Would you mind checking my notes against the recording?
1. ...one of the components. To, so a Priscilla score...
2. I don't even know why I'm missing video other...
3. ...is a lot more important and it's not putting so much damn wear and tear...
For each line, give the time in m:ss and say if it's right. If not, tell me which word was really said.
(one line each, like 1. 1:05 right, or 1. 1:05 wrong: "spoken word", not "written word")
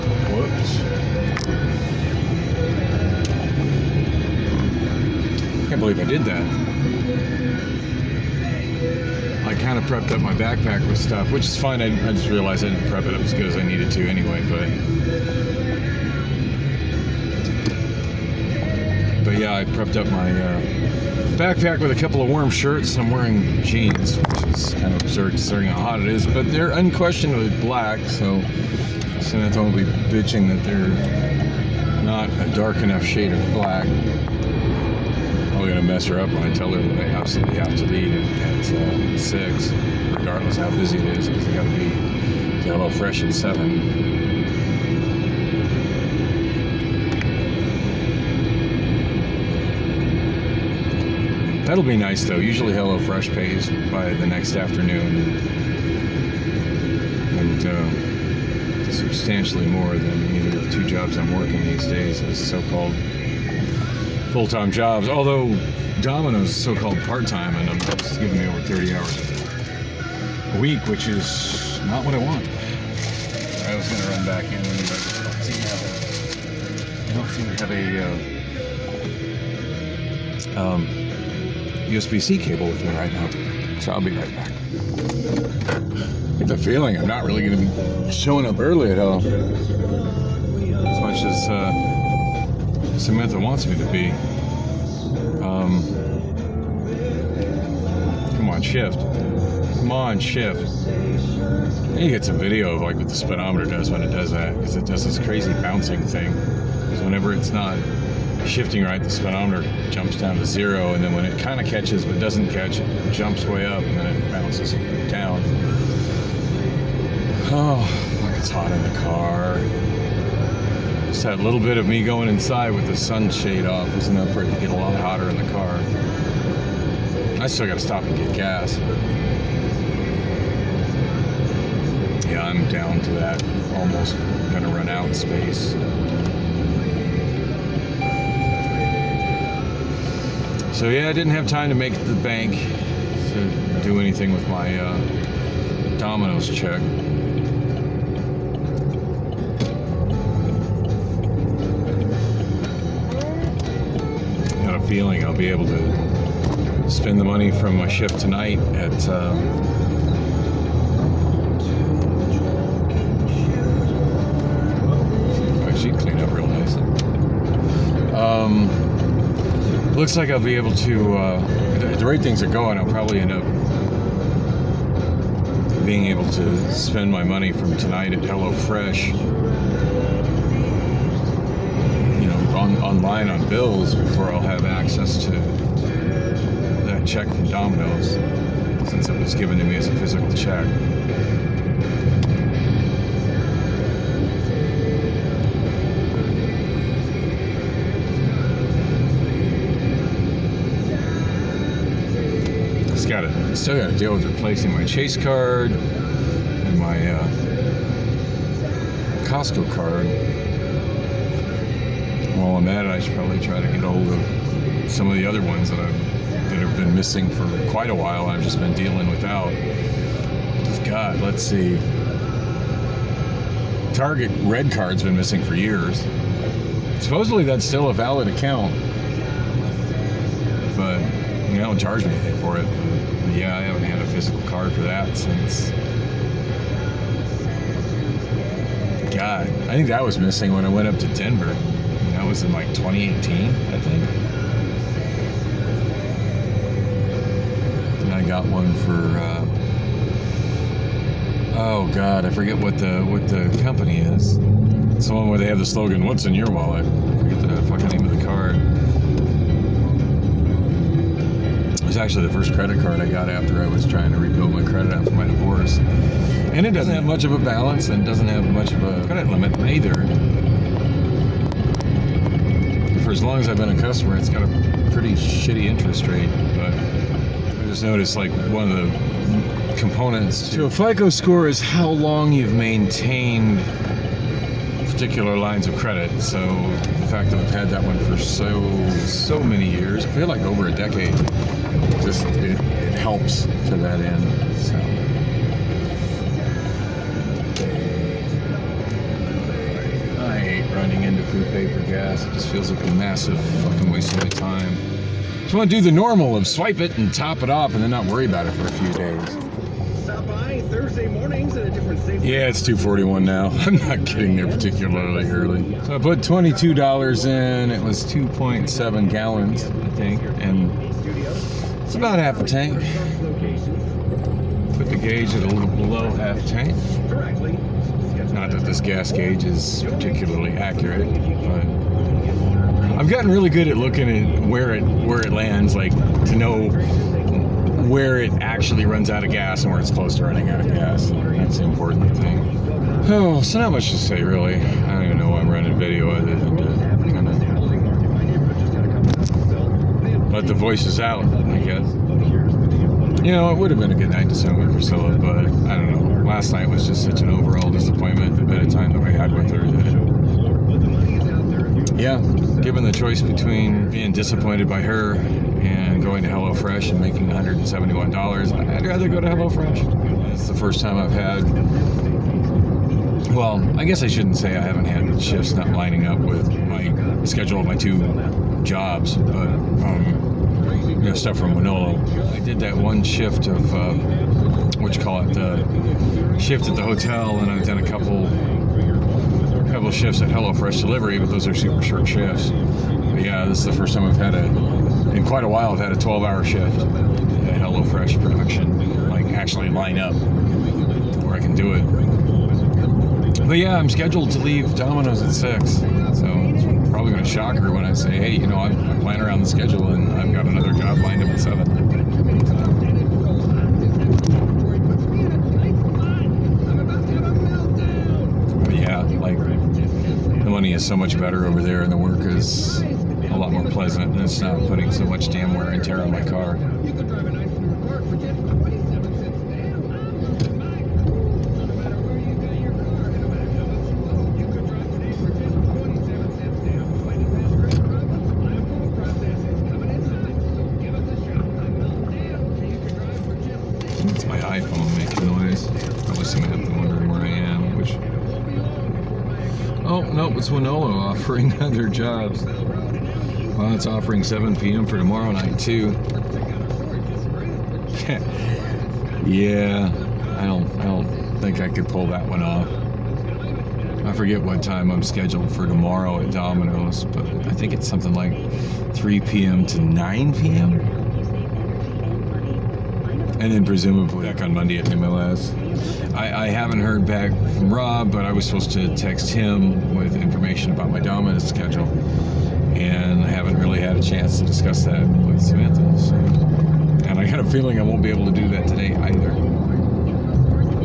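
1. 4:38 wrong: "FICO", not "Priscilla"
2. 5:44 wrong: "running", not "missing"
3. 7:02 wrong: "pleasant", not "important".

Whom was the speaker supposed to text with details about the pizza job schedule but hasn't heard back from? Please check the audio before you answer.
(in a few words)
Rob.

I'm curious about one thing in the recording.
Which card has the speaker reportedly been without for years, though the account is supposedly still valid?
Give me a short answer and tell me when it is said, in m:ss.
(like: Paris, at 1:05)
Target Red Card, at 3:43.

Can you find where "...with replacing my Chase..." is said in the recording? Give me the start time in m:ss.
3:24.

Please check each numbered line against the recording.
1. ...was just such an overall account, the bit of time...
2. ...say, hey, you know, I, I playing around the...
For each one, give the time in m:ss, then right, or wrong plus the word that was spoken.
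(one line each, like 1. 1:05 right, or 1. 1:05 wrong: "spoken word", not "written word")
1. 5:56 wrong: "disappointment", not "account"
2. 6:47 right.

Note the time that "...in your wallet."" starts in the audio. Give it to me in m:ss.
4:16.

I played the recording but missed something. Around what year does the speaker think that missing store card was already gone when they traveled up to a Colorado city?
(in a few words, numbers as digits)
2018.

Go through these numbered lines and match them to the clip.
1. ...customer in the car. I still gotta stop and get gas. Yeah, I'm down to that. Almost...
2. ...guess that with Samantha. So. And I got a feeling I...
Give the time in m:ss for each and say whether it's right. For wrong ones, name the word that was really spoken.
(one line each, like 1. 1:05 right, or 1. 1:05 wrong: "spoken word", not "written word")
1. 2:04 wrong: "hotter", not "customer"
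2. 8:04 wrong: "discuss", not "guess".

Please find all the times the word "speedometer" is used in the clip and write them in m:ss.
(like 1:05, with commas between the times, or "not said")
1:43, 1:49.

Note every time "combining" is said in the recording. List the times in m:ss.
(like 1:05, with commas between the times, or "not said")
not said.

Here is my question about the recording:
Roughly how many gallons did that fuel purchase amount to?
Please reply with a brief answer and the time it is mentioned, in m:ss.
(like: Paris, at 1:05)
2.7, at 5:18.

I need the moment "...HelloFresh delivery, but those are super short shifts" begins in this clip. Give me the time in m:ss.
6:30.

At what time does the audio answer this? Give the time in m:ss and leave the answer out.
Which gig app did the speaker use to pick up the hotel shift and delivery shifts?
6:21.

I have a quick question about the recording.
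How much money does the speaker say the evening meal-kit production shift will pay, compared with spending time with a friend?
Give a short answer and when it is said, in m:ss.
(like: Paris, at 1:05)
$171, at 6:07.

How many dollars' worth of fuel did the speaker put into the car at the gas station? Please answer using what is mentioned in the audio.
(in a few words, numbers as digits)
$22.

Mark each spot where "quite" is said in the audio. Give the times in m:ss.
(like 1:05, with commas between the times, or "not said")
3:37, 6:35.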